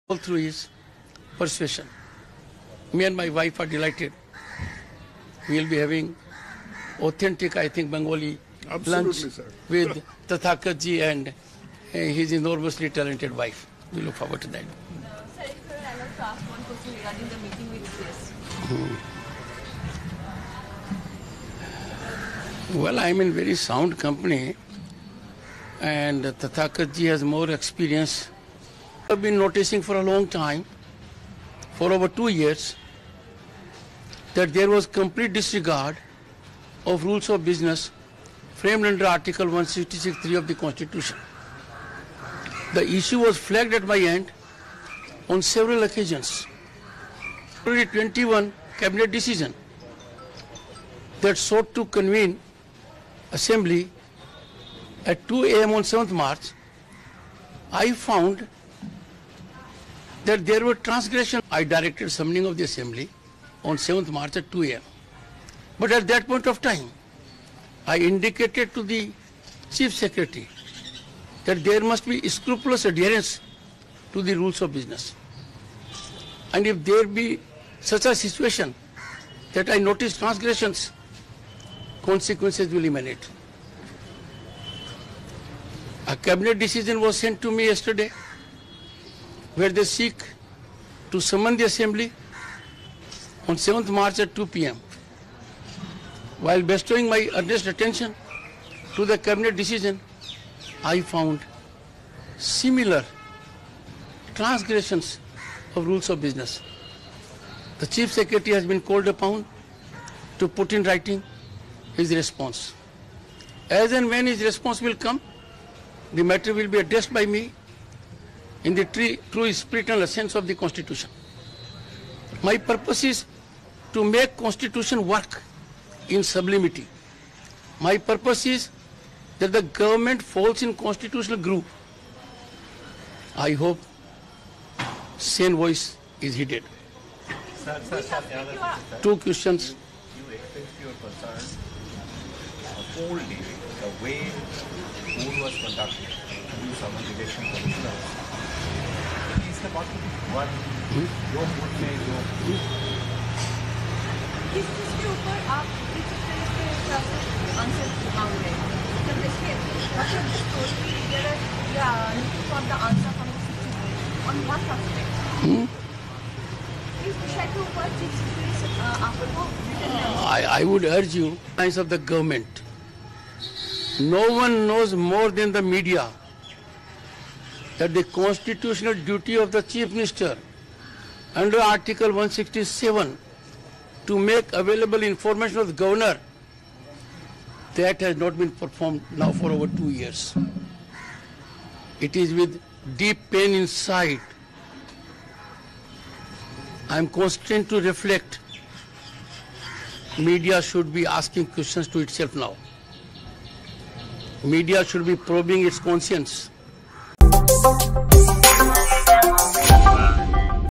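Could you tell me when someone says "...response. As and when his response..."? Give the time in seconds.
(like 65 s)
112 s.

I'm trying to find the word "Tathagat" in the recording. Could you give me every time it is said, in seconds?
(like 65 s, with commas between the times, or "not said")
10 s, 26 s.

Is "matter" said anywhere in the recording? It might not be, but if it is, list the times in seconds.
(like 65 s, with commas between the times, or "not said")
116 s.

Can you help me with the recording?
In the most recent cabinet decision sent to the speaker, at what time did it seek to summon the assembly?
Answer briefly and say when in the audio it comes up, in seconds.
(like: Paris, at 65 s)
2 p.m., at 94 s.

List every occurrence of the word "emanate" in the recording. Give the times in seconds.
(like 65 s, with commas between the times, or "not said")
82 s.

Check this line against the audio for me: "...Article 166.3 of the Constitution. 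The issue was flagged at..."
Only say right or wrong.
right.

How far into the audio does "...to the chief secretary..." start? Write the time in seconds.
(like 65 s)
68 s.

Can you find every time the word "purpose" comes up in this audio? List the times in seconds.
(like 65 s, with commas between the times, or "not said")
122 s, 127 s.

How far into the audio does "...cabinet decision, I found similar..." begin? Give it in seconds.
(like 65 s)
99 s.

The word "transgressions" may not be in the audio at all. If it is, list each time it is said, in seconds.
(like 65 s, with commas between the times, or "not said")
60 s, 80 s, 104 s.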